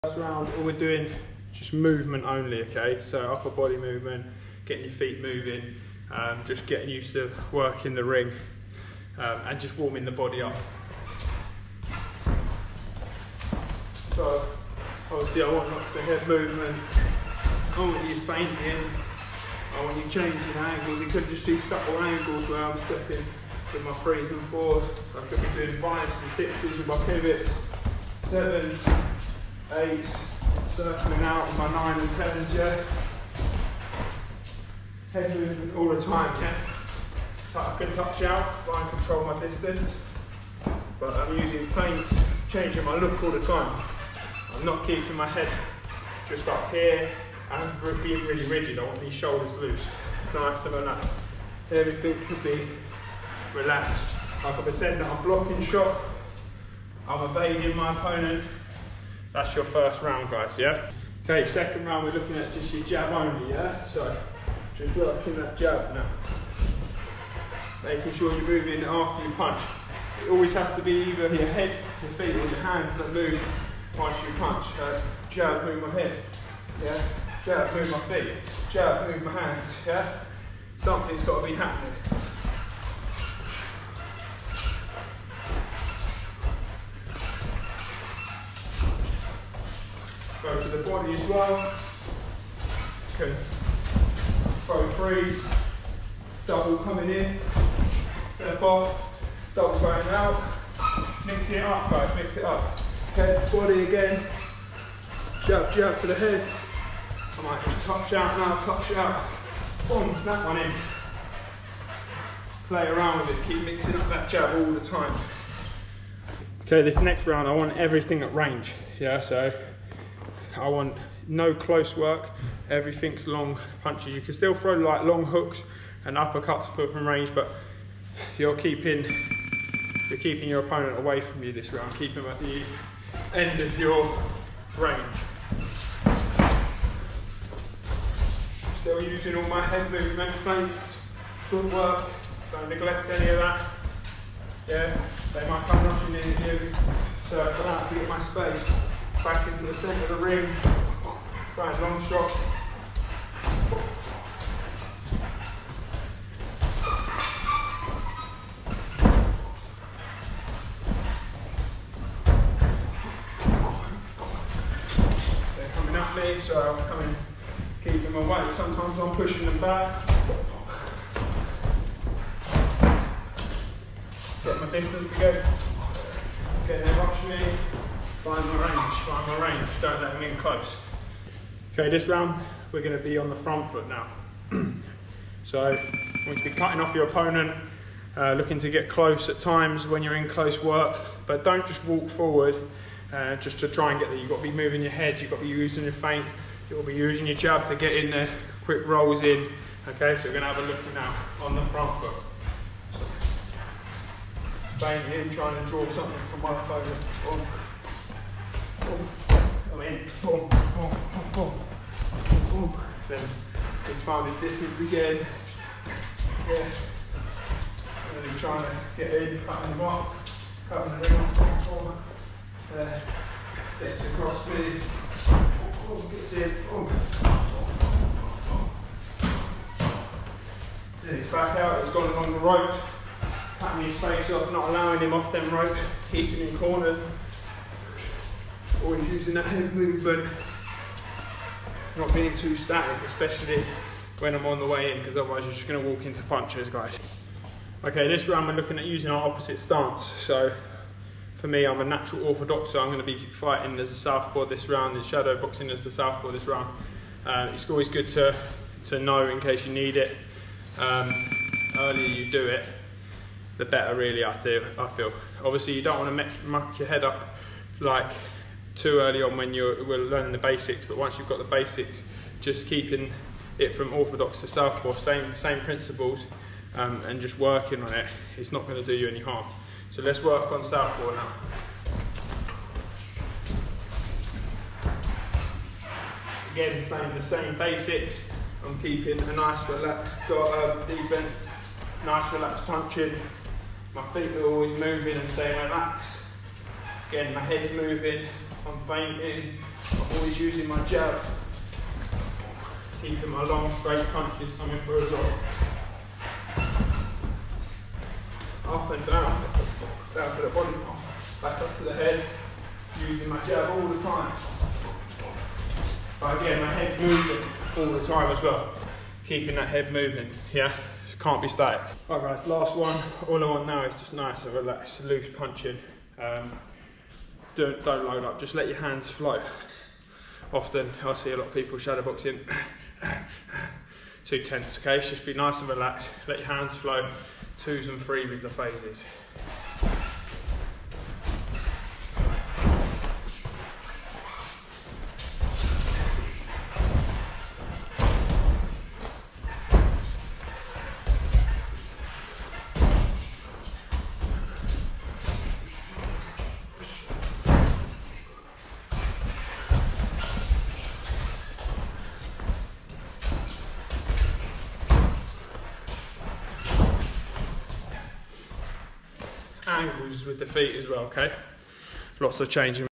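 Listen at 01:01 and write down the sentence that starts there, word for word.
Okay, second round, we're looking at just your jab only, yeah?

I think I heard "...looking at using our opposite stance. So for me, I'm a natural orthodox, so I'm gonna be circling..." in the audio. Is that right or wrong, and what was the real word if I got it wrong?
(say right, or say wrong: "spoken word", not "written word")
wrong: "fighting", not "circling".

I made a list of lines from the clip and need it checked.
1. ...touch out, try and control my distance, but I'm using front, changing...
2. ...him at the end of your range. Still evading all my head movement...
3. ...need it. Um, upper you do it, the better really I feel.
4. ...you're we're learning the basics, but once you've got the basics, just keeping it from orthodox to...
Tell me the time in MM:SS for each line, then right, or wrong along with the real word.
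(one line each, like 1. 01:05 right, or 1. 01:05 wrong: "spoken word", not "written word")
1. 00:37 wrong: "paint", not "front"
2. 02:12 wrong: "using", not "evading"
3. 04:19 wrong: "earlier", not "upper"
4. 04:29 right.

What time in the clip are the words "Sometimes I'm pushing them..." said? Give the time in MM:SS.
02:48.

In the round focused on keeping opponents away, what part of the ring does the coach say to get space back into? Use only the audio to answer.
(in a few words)
the centre of the ring.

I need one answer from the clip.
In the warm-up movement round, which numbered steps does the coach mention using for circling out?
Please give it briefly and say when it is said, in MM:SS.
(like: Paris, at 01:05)
9 and 10, at 00:31.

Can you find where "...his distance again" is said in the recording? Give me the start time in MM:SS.
03:34.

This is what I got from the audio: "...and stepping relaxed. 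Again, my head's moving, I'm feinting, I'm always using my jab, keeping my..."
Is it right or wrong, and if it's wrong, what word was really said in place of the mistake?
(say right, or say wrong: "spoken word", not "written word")
wrong: "staying", not "stepping".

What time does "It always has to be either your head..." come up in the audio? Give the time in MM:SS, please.
01:10.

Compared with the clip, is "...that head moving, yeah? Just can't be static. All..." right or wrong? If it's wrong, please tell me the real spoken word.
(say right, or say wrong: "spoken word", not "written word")
right.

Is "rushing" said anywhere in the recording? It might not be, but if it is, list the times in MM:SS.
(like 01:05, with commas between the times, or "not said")
02:25, 02:56.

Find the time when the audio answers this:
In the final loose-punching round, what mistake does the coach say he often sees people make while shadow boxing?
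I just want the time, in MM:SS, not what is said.
05:34.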